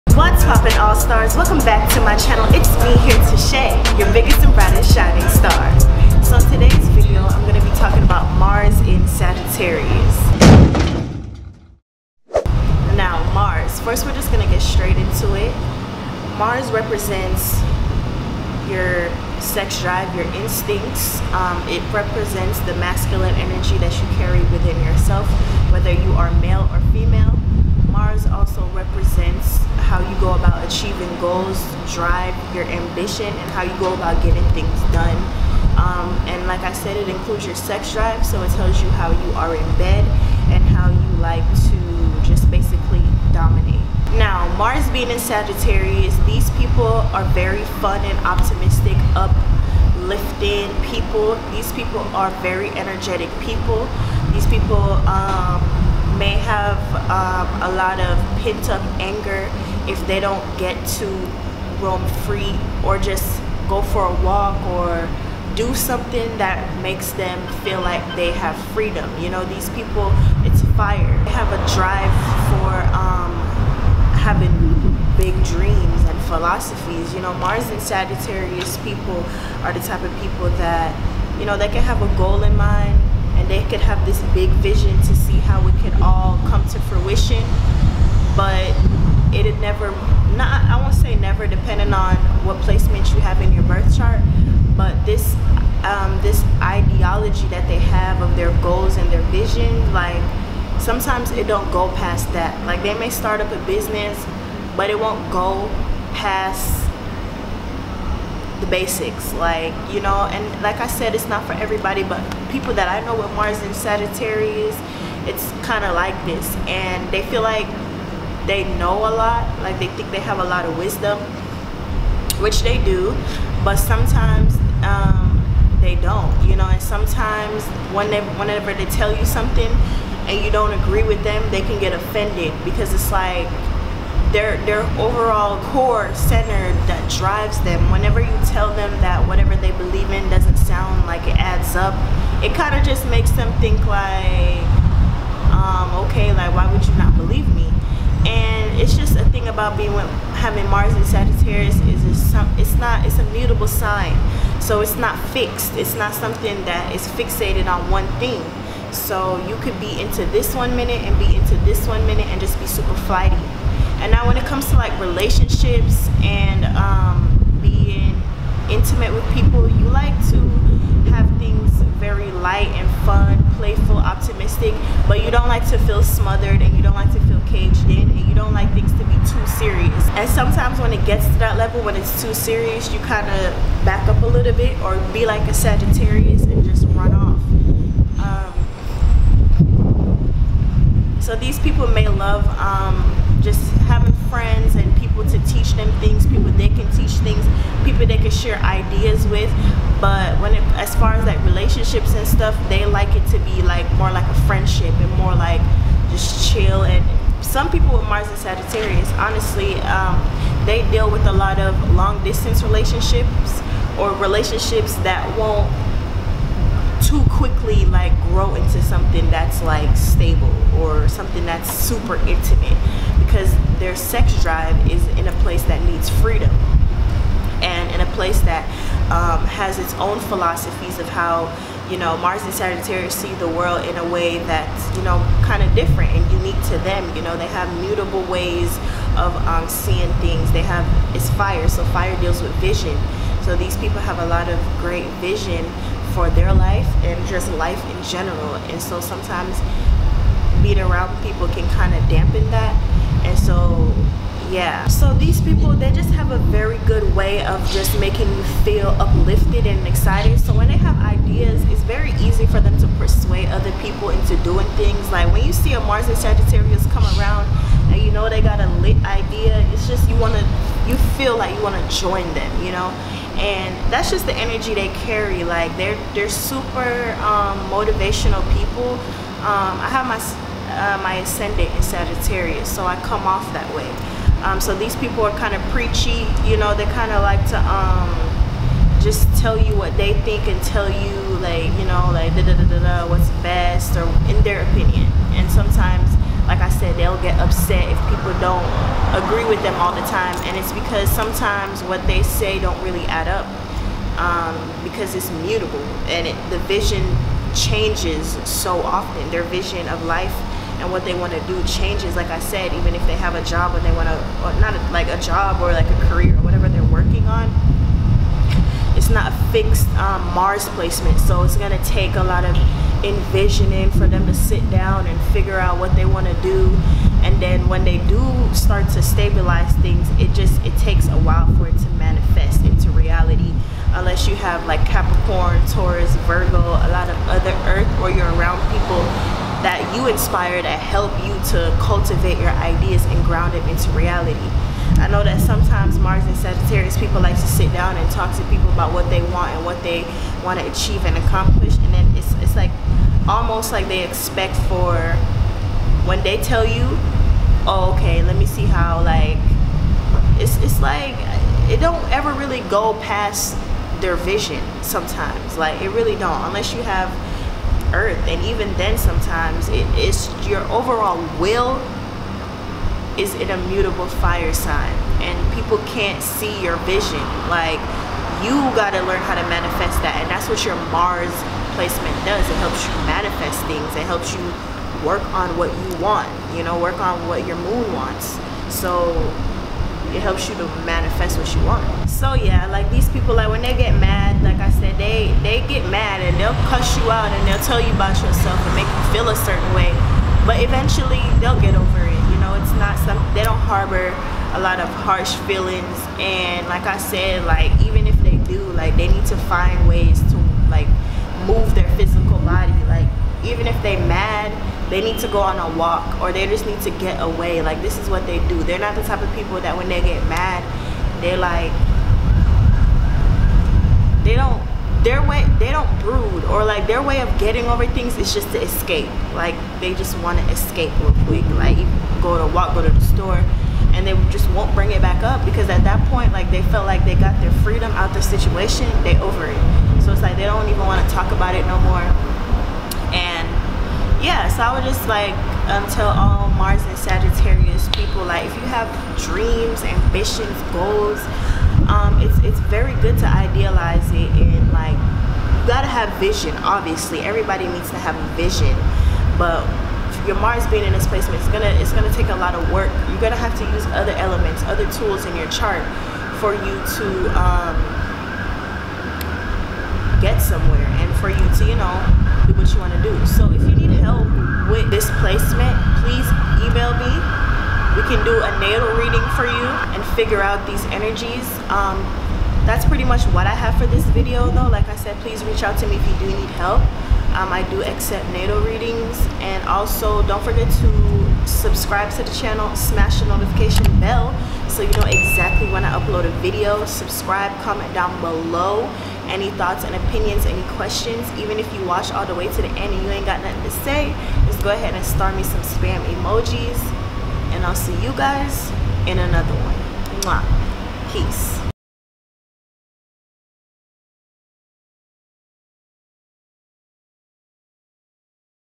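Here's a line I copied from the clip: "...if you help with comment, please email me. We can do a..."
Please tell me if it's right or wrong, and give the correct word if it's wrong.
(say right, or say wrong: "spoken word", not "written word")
wrong: "displacement", not "comment".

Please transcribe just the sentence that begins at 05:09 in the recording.
Their vision of life and what they want to do changes.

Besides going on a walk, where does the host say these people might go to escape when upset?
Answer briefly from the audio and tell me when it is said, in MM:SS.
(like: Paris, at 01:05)
the store, at 07:12.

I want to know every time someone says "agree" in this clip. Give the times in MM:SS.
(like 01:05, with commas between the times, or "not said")
02:10, 04:59.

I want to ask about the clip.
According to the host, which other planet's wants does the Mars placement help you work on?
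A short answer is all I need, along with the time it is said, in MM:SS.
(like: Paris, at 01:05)
moon, at 06:27.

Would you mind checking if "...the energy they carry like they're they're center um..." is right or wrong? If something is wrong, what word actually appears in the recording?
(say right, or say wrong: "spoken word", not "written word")
wrong: "super", not "center".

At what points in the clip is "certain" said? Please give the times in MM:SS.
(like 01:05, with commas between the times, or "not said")
06:39.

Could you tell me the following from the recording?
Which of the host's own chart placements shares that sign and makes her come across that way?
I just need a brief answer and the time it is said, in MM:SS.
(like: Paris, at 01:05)
ascendant, at 04:41.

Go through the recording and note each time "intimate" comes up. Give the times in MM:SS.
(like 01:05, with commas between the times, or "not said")
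02:48, 03:42.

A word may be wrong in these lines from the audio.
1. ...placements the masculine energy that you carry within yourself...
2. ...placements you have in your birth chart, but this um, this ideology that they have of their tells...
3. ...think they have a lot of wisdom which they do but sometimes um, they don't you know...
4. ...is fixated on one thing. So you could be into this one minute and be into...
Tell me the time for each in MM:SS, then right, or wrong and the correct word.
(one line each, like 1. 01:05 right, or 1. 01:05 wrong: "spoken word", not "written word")
1. 00:21 wrong: "represents", not "placements"
2. 01:32 wrong: "goals", not "tells"
3. 01:59 right
4. 02:36 right.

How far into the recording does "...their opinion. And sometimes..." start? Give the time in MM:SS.
04:54.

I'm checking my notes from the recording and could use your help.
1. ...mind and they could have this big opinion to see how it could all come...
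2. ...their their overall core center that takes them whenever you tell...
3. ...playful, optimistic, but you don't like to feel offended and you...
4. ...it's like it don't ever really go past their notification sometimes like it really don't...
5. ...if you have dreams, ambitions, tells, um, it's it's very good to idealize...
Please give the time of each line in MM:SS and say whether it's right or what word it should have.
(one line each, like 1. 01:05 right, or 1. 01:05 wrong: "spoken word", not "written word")
1. 01:22 wrong: "vision", not "opinion"
2. 02:14 wrong: "drives", not "takes"
3. 02:53 wrong: "smothered", not "offended"
4. 06:00 wrong: "vision", not "notification"
5. 07:28 wrong: "goals", not "tells".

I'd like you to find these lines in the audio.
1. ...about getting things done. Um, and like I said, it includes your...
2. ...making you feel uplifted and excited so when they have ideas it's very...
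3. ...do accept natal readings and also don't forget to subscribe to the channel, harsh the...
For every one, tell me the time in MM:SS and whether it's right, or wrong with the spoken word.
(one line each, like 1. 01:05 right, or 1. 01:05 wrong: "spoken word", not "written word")
1. 00:33 right
2. 04:18 right
3. 08:07 wrong: "smash", not "harsh".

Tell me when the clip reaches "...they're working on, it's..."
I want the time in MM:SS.
05:16.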